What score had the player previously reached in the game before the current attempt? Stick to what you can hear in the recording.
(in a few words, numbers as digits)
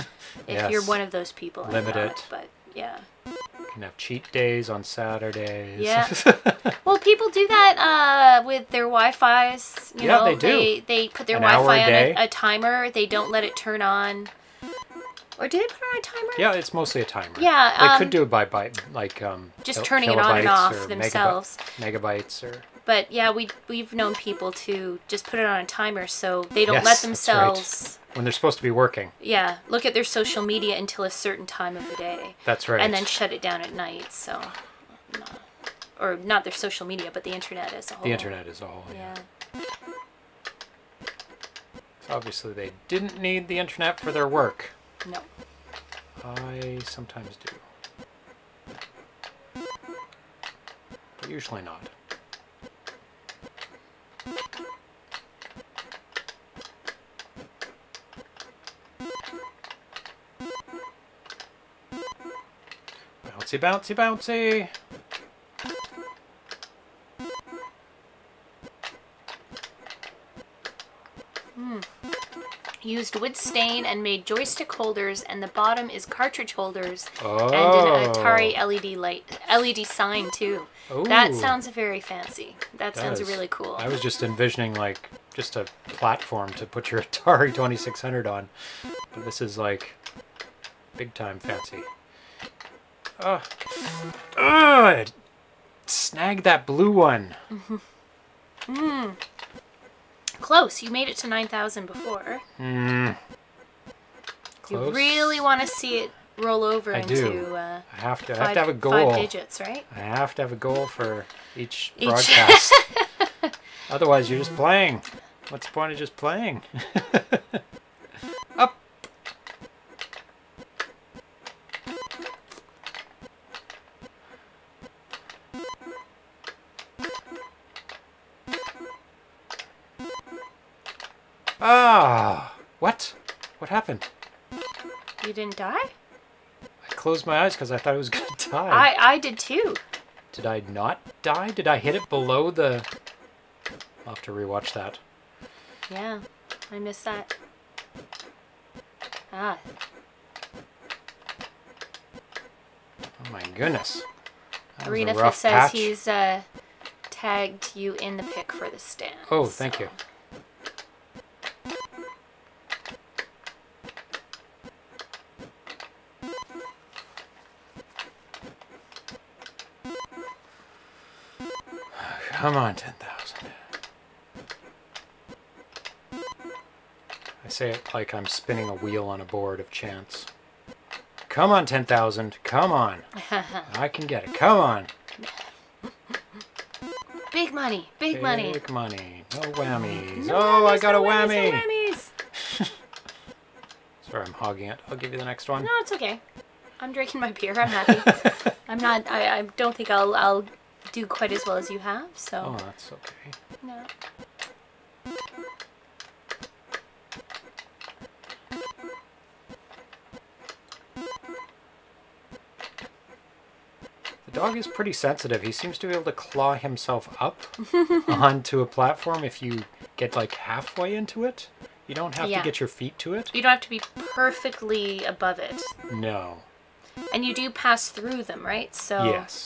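9,000.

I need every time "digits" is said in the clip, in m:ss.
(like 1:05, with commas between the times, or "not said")
1:49.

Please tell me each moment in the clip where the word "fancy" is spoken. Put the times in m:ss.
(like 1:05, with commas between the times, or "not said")
1:21, 1:31.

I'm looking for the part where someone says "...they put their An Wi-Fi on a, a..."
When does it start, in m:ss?
0:10.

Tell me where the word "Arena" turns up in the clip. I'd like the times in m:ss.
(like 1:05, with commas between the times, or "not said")
2:34.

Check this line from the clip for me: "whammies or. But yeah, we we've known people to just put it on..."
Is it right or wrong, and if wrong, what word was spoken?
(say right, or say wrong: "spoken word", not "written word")
wrong: "megabytes", not "whammies".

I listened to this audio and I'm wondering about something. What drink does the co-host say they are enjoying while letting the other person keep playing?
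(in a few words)
beer.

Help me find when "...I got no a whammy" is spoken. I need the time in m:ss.
3:10.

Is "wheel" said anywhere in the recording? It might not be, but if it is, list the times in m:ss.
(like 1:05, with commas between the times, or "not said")
2:58.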